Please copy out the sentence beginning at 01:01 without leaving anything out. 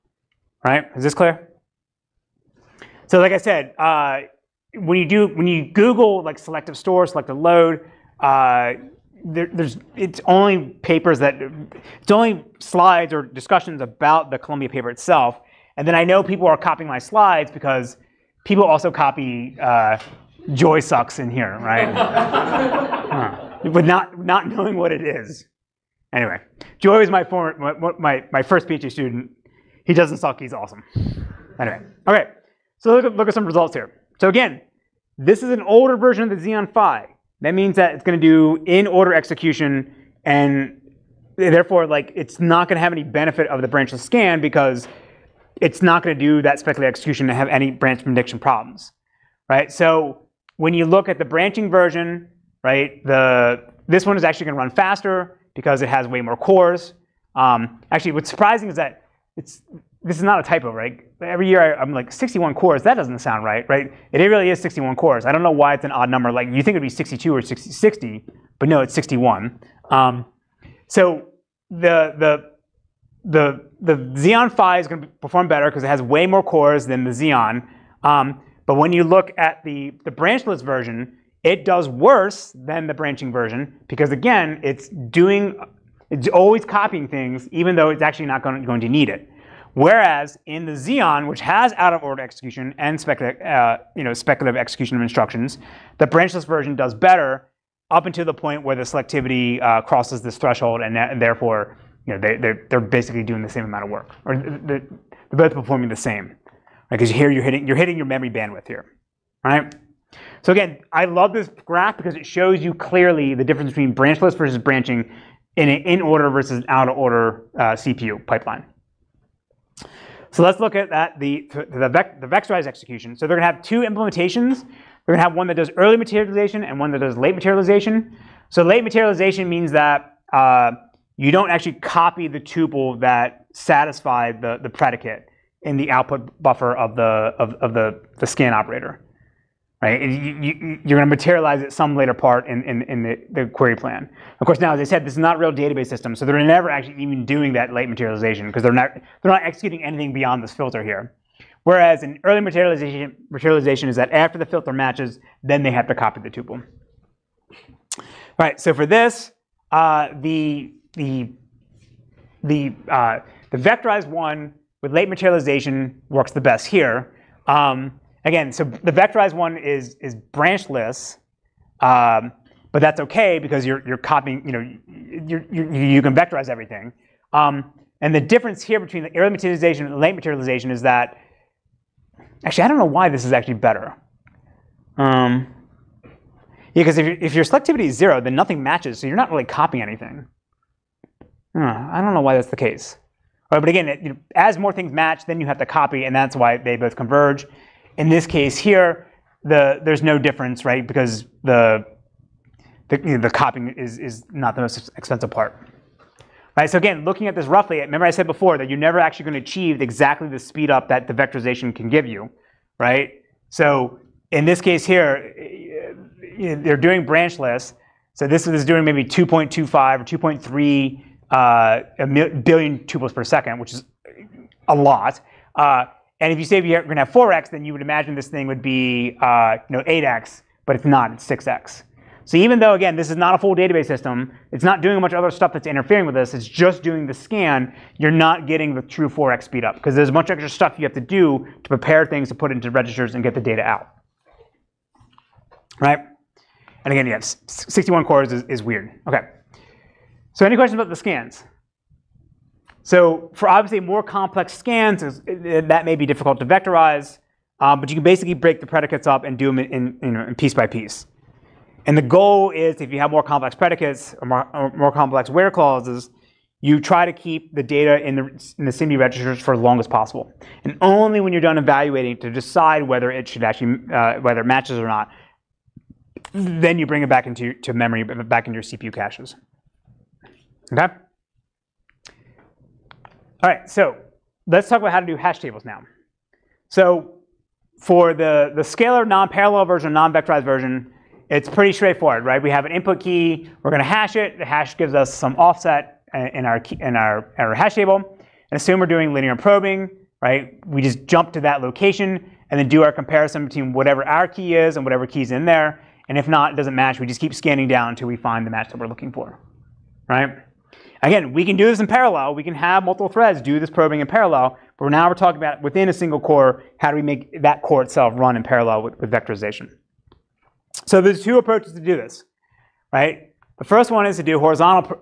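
Every year I, am like, 61 cores, that doesn't sound right, right?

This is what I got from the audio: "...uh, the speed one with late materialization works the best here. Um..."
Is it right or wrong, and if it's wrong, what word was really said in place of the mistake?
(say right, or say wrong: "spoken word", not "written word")
wrong: "vectorized", not "speed".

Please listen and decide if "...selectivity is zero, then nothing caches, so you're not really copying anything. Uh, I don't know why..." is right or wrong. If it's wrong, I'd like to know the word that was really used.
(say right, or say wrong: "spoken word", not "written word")
wrong: "matches", not "caches".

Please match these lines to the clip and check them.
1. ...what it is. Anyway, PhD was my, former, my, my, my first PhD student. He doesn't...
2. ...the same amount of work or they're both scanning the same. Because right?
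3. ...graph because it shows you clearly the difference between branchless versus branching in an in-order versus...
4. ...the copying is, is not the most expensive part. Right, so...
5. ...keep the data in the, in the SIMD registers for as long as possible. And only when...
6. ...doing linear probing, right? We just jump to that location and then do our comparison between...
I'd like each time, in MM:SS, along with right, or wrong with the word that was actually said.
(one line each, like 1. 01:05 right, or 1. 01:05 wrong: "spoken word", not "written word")
1. 00:24 wrong: "Joy", not "PhD"
2. 01:43 wrong: "performing", not "scanning"
3. 01:51 right
4. 03:23 right
5. 04:27 right
6. 04:58 right.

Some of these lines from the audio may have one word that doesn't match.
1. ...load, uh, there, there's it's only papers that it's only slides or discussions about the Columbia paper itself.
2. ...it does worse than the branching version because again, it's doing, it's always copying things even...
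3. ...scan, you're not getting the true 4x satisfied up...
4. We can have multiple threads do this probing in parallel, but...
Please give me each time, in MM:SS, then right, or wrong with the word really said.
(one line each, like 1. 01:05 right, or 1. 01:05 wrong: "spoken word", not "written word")
1. 00:07 right
2. 01:21 right
3. 03:57 wrong: "speed", not "satisfied"
4. 05:12 right.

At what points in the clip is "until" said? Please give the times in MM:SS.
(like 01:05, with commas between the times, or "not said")
01:38, 05:07.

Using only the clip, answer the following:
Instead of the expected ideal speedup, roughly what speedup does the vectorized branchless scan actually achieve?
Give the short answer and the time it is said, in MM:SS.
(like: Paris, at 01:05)
6x, at 03:51.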